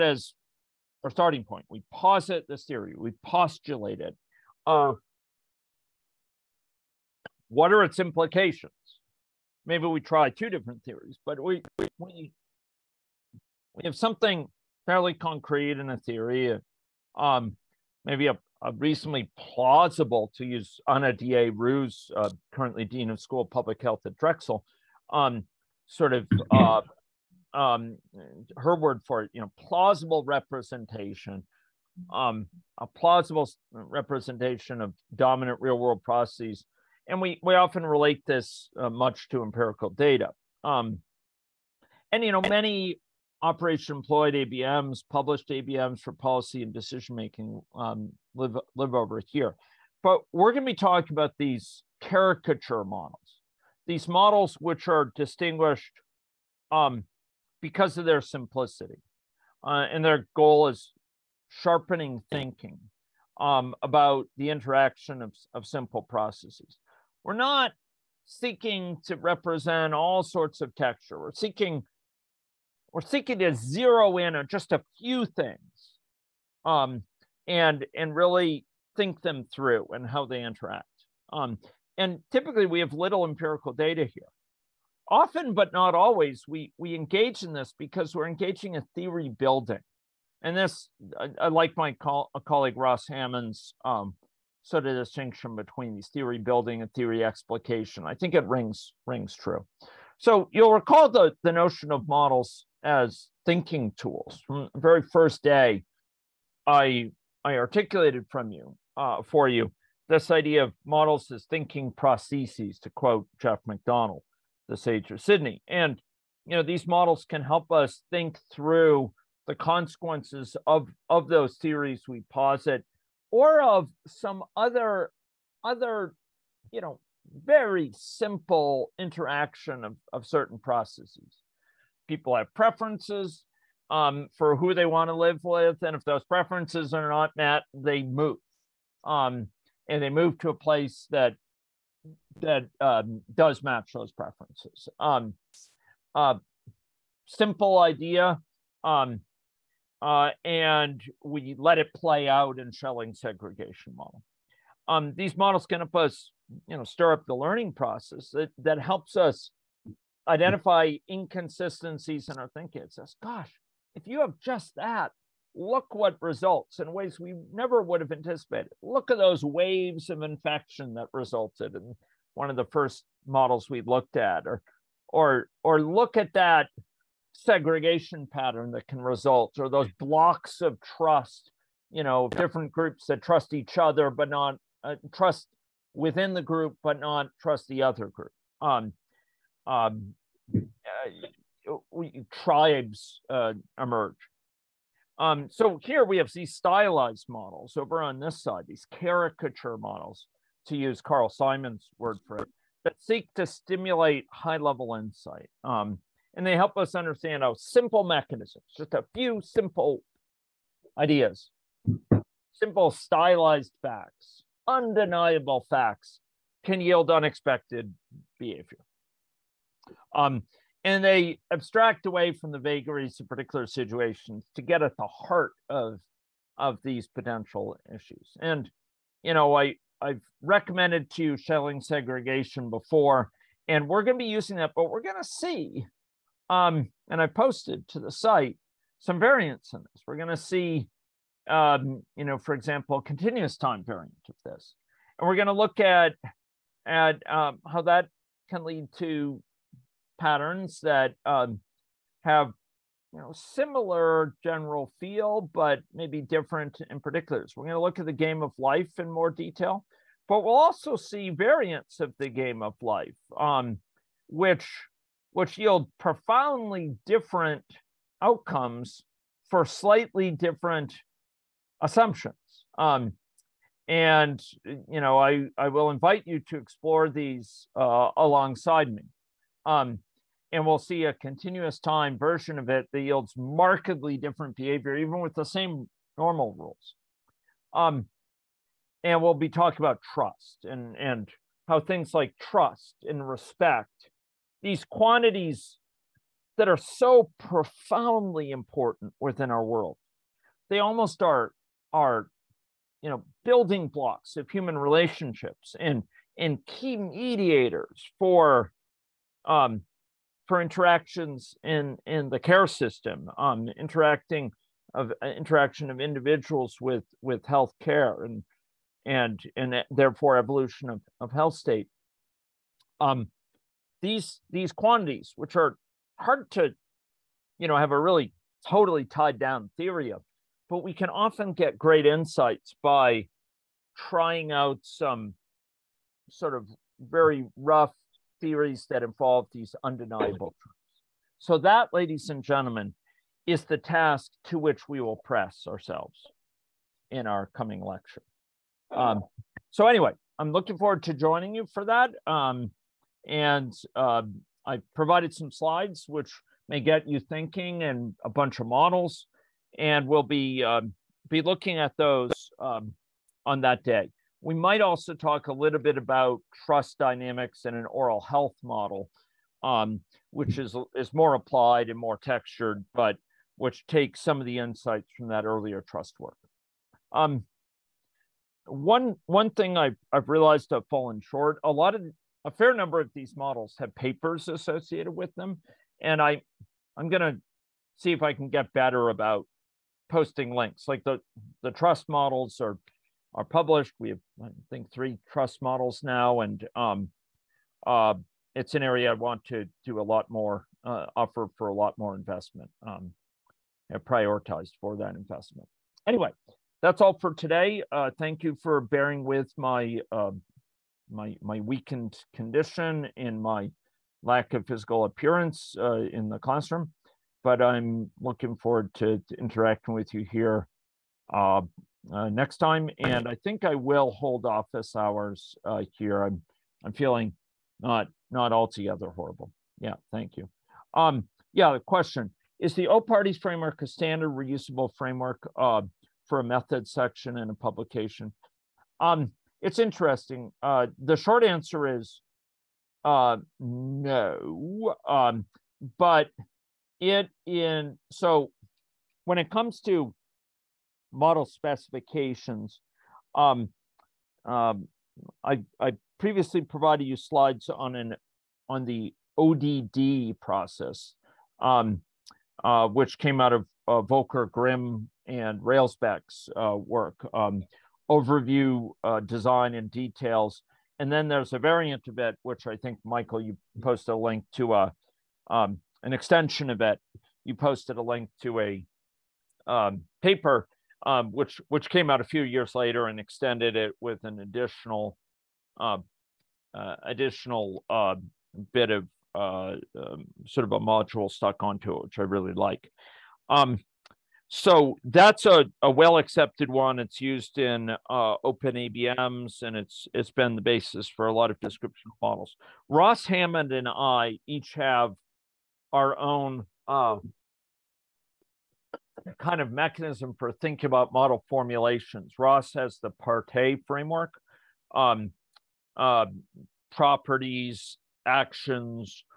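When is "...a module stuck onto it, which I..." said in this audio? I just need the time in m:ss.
8:10.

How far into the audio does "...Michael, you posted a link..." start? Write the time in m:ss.
7:53.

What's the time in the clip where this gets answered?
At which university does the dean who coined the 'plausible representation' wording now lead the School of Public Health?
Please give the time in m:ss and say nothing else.
0:24.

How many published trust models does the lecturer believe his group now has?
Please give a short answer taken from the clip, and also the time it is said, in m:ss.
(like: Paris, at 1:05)
3, at 6:34.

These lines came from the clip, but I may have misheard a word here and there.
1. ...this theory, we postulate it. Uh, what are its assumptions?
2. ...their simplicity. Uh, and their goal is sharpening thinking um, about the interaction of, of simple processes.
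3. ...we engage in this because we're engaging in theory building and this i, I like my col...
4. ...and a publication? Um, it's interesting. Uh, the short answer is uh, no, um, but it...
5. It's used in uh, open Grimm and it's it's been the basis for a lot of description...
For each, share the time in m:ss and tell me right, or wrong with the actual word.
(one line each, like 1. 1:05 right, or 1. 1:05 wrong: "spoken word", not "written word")
1. 0:02 wrong: "implications", not "assumptions"
2. 0:58 right
3. 1:26 right
4. 7:17 right
5. 8:16 wrong: "ABMs", not "Grimm".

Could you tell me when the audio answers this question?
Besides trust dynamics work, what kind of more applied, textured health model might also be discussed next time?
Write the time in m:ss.
6:07.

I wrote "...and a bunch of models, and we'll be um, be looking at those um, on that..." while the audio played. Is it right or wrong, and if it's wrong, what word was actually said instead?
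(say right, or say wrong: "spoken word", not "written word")
right.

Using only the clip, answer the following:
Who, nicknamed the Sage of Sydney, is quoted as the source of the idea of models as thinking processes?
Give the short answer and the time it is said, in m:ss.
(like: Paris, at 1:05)
Geoff McDonnell, at 1:53.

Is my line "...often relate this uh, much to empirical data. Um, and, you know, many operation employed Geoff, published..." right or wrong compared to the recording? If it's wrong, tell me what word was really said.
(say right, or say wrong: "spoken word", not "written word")
wrong: "ABMs", not "Geoff".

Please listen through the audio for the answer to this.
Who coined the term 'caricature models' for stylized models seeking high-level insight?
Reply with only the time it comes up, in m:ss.
3:21.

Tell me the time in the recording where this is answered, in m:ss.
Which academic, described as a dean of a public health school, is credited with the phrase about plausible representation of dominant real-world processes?
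0:20.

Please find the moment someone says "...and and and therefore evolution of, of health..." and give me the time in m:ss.
5:18.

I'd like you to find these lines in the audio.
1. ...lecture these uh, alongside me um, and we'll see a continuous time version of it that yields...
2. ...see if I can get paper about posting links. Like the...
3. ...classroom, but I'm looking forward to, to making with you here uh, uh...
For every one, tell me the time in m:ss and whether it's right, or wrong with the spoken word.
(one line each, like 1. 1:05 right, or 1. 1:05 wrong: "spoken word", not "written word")
1. 4:36 wrong: "explore", not "lecture"
2. 6:27 wrong: "better", not "paper"
3. 6:56 wrong: "interacting", not "making".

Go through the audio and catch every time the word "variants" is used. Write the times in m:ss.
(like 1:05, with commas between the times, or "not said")
3:59, 4:03, 4:21, 7:51.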